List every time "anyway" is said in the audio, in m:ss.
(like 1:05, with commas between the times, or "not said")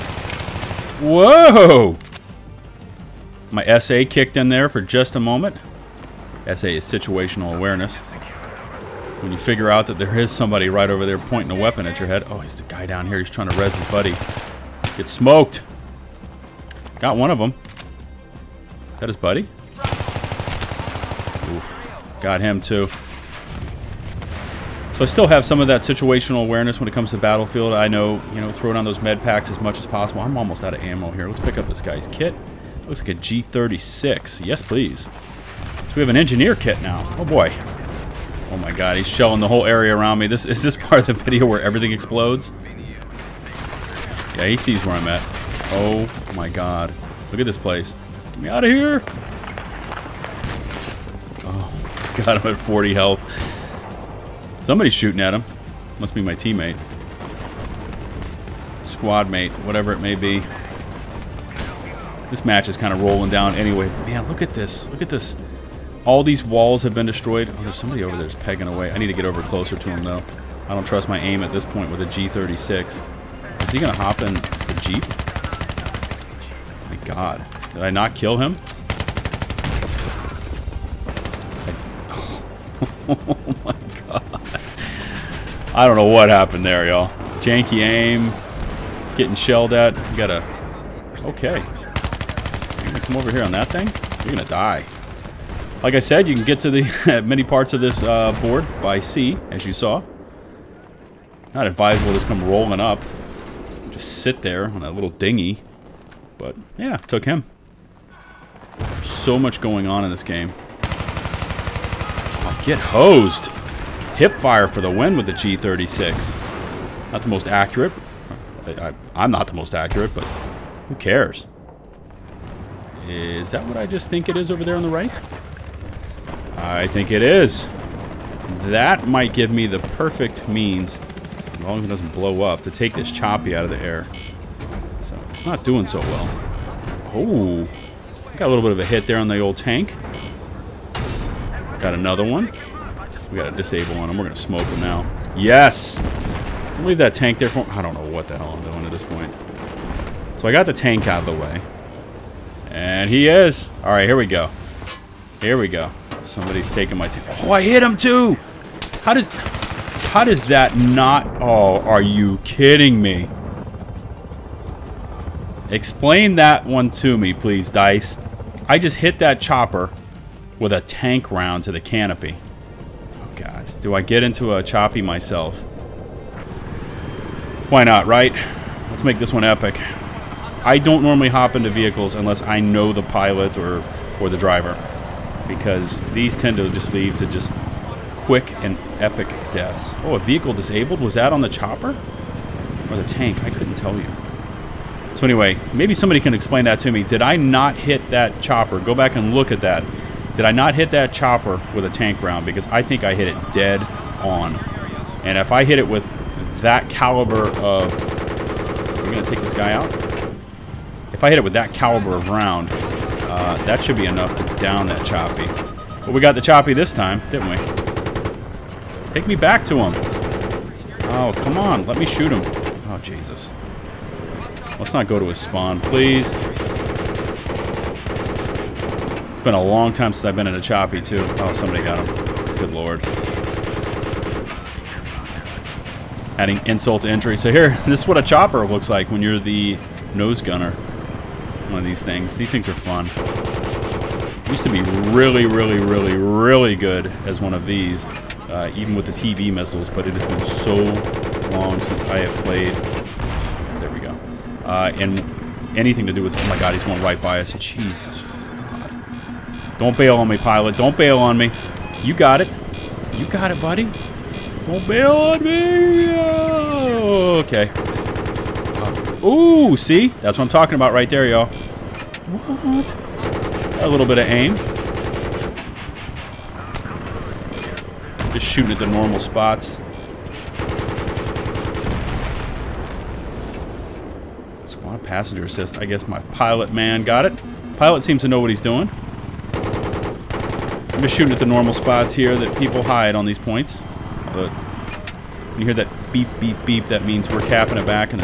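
1:03, 3:15.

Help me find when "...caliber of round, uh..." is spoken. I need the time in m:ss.
3:31.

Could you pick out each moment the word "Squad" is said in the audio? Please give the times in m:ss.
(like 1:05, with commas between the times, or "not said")
0:58, 4:44.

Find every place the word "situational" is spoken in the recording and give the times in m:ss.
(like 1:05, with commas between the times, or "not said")
0:06, 0:25.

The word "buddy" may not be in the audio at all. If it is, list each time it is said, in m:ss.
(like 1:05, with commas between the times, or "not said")
0:13, 0:19, 4:23.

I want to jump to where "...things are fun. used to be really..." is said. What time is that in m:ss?
4:02.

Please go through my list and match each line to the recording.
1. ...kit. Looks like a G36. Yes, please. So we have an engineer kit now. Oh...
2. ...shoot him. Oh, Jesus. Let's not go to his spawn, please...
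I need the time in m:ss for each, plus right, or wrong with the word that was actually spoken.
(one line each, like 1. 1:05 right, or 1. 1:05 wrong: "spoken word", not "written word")
1. 0:32 right
2. 3:42 right.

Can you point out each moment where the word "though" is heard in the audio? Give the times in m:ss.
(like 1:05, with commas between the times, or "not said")
1:10.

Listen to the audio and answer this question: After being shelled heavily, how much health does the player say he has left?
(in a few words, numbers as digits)
40.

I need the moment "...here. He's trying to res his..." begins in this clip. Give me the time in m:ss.
0:13.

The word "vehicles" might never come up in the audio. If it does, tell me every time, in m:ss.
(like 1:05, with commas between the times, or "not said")
3:01, 3:10.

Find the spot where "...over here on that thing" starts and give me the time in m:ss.
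1:33.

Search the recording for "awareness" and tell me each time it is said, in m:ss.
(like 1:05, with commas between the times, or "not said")
0:07, 0:26.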